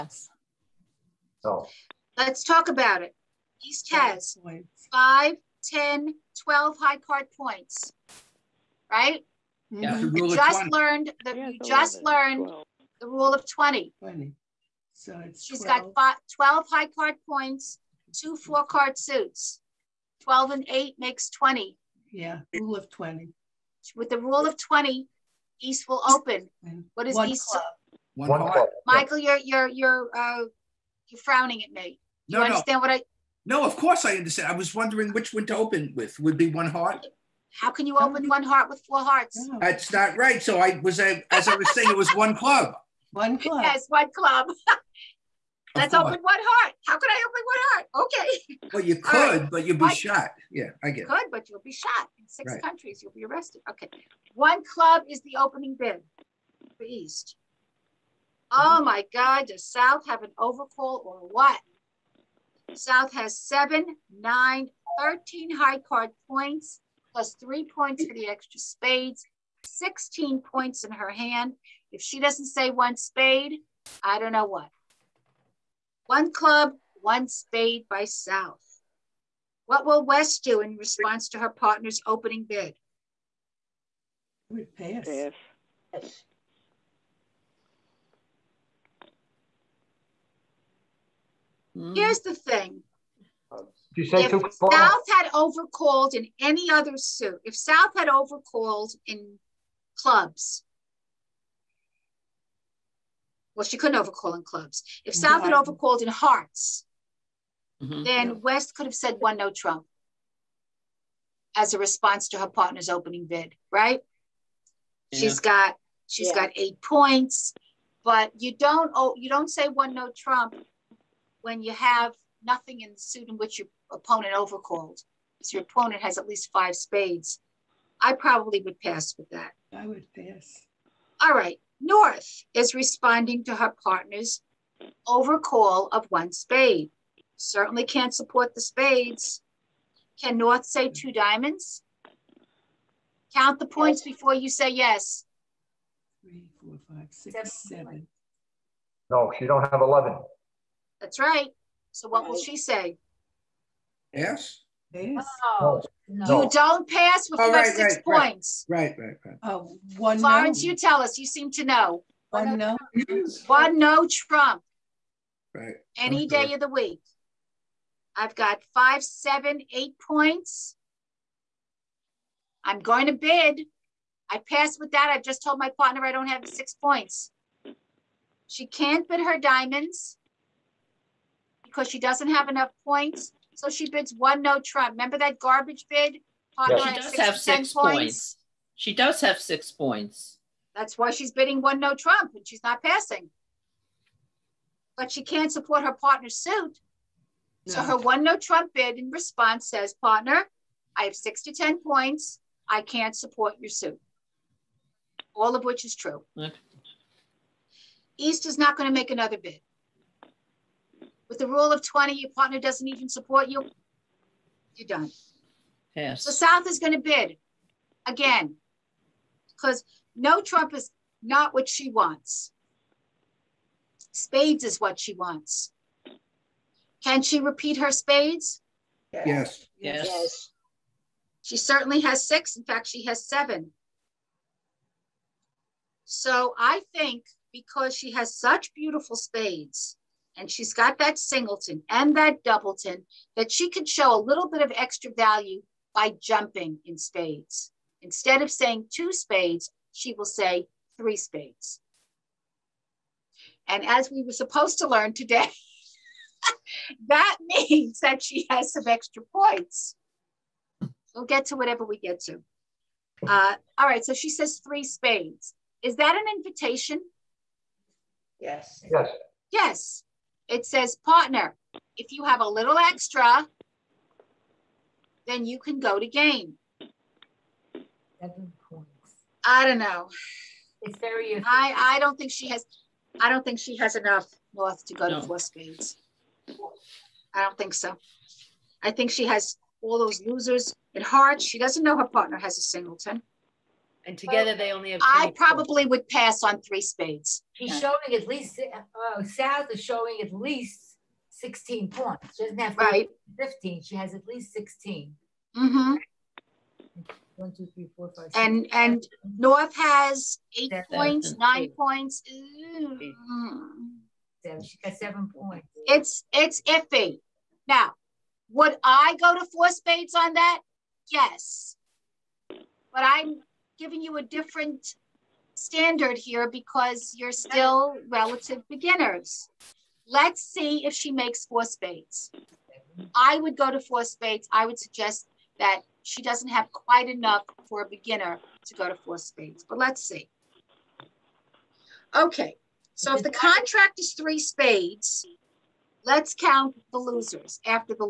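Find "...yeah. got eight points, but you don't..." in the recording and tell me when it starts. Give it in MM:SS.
01:56.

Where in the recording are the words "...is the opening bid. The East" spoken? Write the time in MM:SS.
00:55.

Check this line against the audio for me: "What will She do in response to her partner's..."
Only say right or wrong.
wrong.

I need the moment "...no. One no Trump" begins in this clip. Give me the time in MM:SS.
02:42.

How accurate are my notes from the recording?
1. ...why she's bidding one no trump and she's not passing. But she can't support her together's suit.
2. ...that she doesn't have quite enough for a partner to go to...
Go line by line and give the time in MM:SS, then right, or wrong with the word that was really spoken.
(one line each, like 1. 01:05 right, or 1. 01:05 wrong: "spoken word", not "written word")
1. 03:10 wrong: "partner", not "together"
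2. 05:35 wrong: "beginner", not "partner".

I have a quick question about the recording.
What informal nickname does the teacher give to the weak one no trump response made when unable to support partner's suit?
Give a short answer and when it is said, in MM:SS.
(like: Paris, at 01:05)
garbage bid, at 03:05.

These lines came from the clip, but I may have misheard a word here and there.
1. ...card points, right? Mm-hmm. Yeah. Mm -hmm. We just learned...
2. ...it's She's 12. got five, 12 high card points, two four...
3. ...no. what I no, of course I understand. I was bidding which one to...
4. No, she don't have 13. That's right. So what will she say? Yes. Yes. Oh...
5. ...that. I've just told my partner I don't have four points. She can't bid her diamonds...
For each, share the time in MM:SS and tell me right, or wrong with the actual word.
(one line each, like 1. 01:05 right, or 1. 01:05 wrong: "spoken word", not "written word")
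1. 00:06 right
2. 00:15 right
3. 00:32 wrong: "wondering", not "bidding"
4. 02:29 wrong: "11", not "13"
5. 02:54 wrong: "six", not "four".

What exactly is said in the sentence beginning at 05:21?
Yes, but I'm giving you a different standard here because you're still relative beginners.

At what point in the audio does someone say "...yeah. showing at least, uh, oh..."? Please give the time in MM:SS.
04:57.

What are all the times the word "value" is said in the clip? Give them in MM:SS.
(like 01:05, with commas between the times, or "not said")
04:05.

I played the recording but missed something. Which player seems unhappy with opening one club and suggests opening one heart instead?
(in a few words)
Michael.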